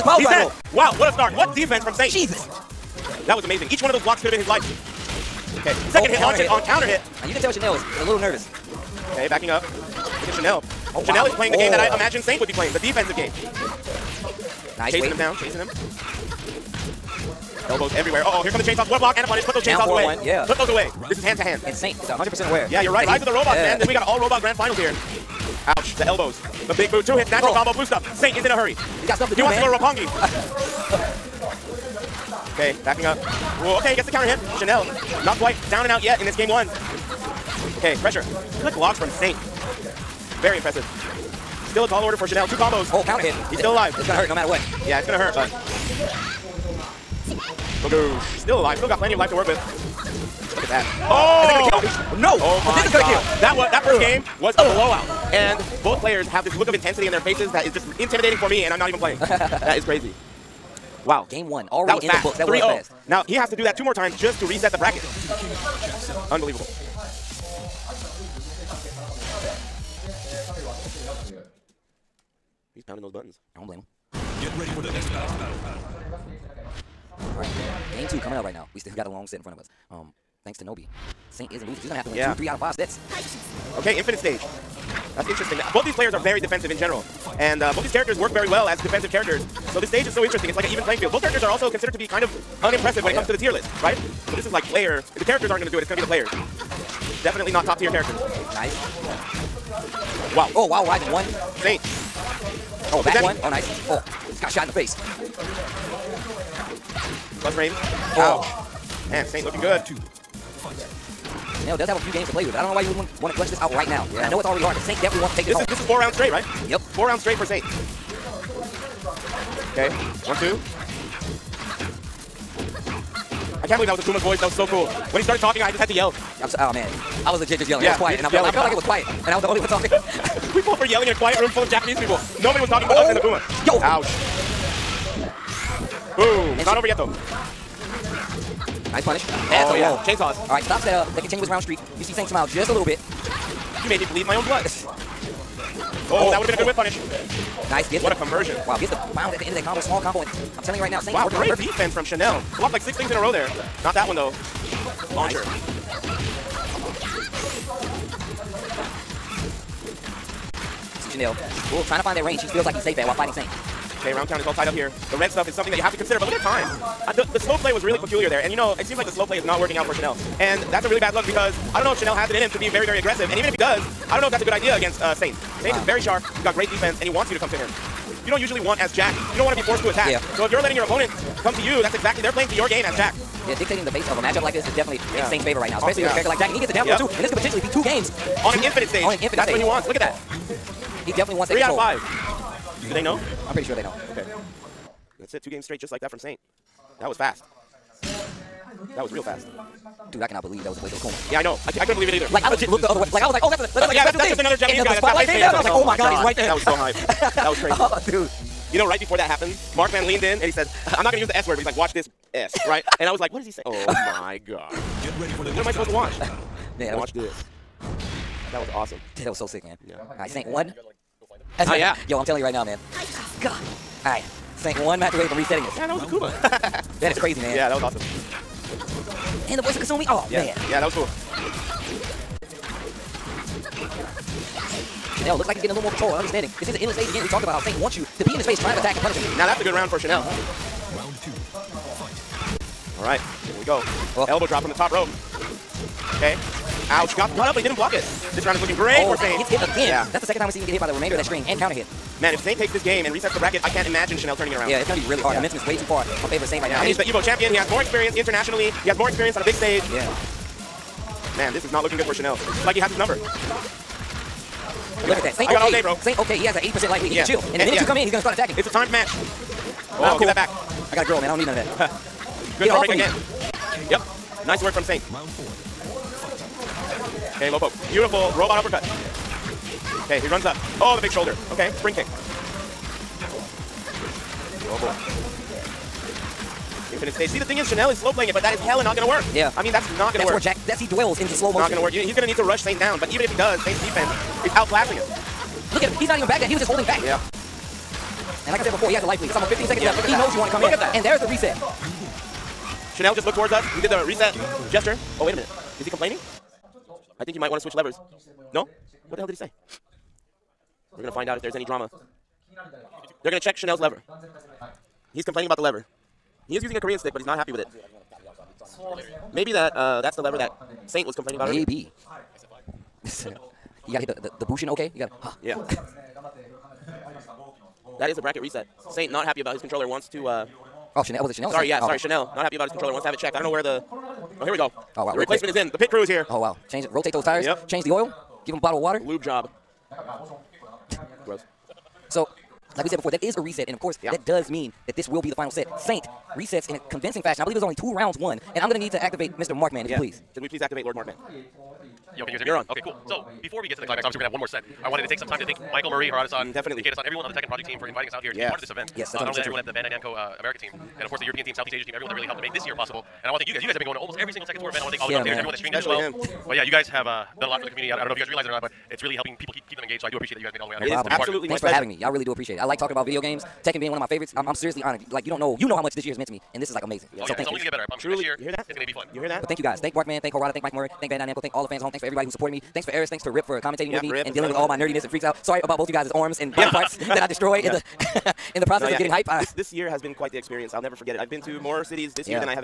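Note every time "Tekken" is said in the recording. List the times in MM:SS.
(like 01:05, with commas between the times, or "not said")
05:57, 06:04, 06:13.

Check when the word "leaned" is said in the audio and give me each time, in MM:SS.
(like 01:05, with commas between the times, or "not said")
03:30.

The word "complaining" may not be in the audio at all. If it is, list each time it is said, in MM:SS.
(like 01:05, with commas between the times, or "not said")
05:05, 05:15, 05:21.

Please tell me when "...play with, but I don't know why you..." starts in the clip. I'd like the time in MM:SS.
01:52.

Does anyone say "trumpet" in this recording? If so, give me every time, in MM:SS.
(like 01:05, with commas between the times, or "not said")
not said.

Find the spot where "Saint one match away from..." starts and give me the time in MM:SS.
03:44.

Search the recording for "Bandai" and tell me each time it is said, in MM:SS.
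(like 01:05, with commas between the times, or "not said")
05:59, 06:21.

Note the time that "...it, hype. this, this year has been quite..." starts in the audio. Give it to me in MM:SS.
06:29.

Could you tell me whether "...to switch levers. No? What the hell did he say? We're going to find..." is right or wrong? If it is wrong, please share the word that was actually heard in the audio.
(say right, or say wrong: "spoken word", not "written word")
right.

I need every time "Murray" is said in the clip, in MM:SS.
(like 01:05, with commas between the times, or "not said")
05:55, 06:20.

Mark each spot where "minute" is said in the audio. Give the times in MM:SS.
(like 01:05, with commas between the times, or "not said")
04:27, 05:05.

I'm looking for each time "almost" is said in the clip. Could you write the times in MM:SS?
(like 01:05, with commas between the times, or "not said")
04:59, 06:03.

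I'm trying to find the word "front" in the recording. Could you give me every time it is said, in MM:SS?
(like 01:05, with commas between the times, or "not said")
01:19.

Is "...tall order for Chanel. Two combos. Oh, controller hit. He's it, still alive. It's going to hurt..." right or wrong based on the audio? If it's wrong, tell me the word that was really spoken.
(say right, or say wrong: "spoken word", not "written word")
wrong: "counter", not "controller".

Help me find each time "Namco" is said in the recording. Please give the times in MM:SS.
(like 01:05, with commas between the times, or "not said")
05:59, 06:21.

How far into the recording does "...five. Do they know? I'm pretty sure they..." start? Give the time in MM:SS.
03:11.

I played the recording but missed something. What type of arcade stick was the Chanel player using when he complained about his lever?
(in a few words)
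Korean stick.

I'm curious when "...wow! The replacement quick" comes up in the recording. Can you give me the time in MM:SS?
05:35.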